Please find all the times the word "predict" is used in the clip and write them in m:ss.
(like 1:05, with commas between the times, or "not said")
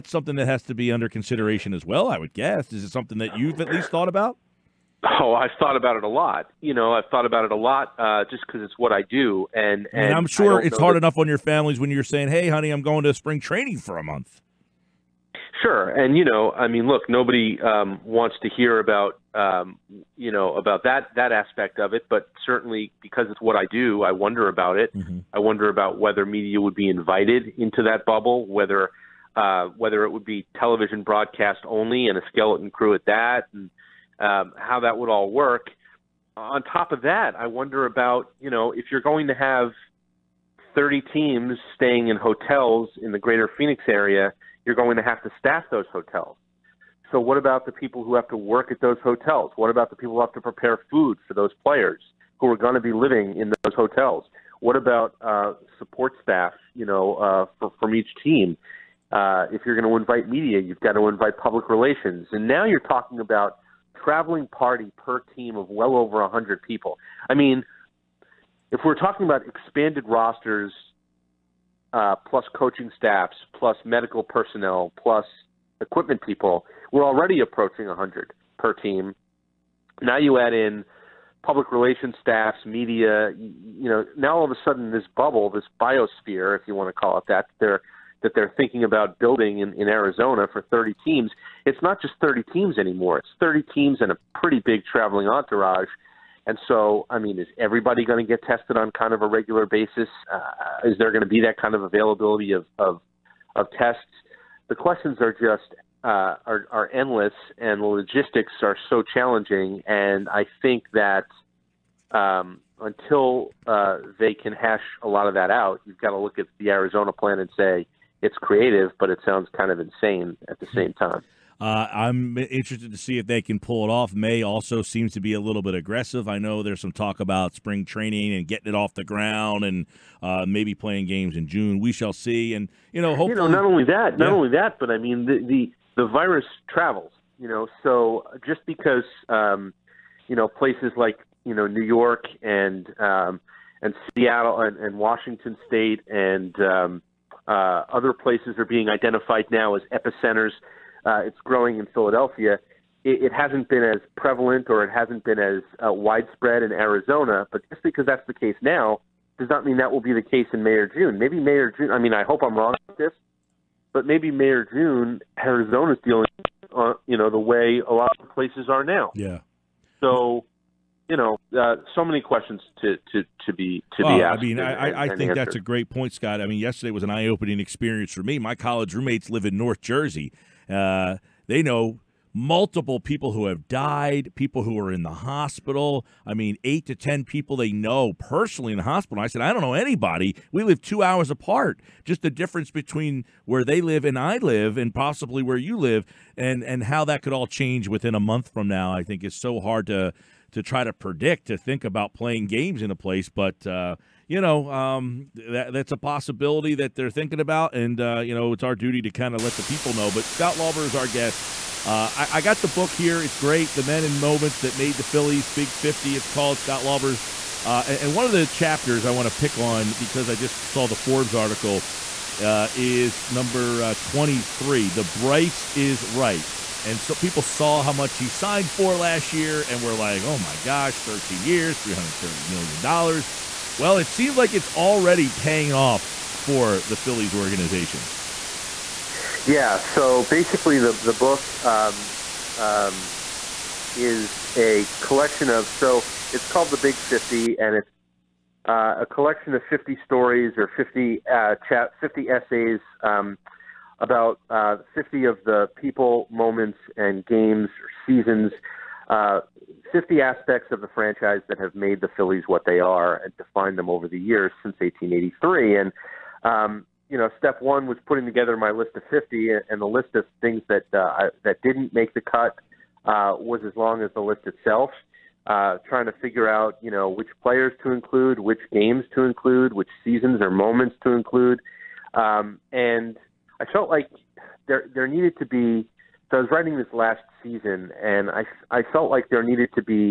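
3:20.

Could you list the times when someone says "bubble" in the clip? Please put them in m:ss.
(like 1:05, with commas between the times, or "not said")
0:28, 1:25.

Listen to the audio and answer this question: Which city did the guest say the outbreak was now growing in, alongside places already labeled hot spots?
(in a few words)
Philadelphia.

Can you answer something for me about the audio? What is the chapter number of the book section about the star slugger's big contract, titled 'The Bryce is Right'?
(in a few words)
23.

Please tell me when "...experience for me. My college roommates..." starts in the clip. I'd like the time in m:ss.
2:57.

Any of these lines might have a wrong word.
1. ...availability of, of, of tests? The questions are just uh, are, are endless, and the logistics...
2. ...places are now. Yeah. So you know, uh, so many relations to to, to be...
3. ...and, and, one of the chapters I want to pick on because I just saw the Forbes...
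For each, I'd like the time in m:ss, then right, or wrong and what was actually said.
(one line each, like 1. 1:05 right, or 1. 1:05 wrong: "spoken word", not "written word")
1. 1:41 right
2. 2:48 wrong: "questions", not "relations"
3. 3:37 right.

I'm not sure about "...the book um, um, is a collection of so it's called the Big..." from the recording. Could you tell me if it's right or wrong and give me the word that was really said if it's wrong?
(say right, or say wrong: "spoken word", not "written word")
right.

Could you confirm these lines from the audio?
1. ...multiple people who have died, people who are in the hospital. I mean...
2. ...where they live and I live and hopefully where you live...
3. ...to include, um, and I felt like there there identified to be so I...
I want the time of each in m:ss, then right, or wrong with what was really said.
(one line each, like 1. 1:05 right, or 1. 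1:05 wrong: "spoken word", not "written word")
1. 3:02 right
2. 3:13 wrong: "possibly", not "hopefully"
3. 4:41 wrong: "needed", not "identified".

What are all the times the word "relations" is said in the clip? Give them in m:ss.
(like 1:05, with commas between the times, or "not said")
1:01, 1:21.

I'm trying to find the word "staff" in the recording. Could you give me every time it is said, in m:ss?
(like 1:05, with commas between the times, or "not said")
0:45, 0:56, 1:12, 1:22.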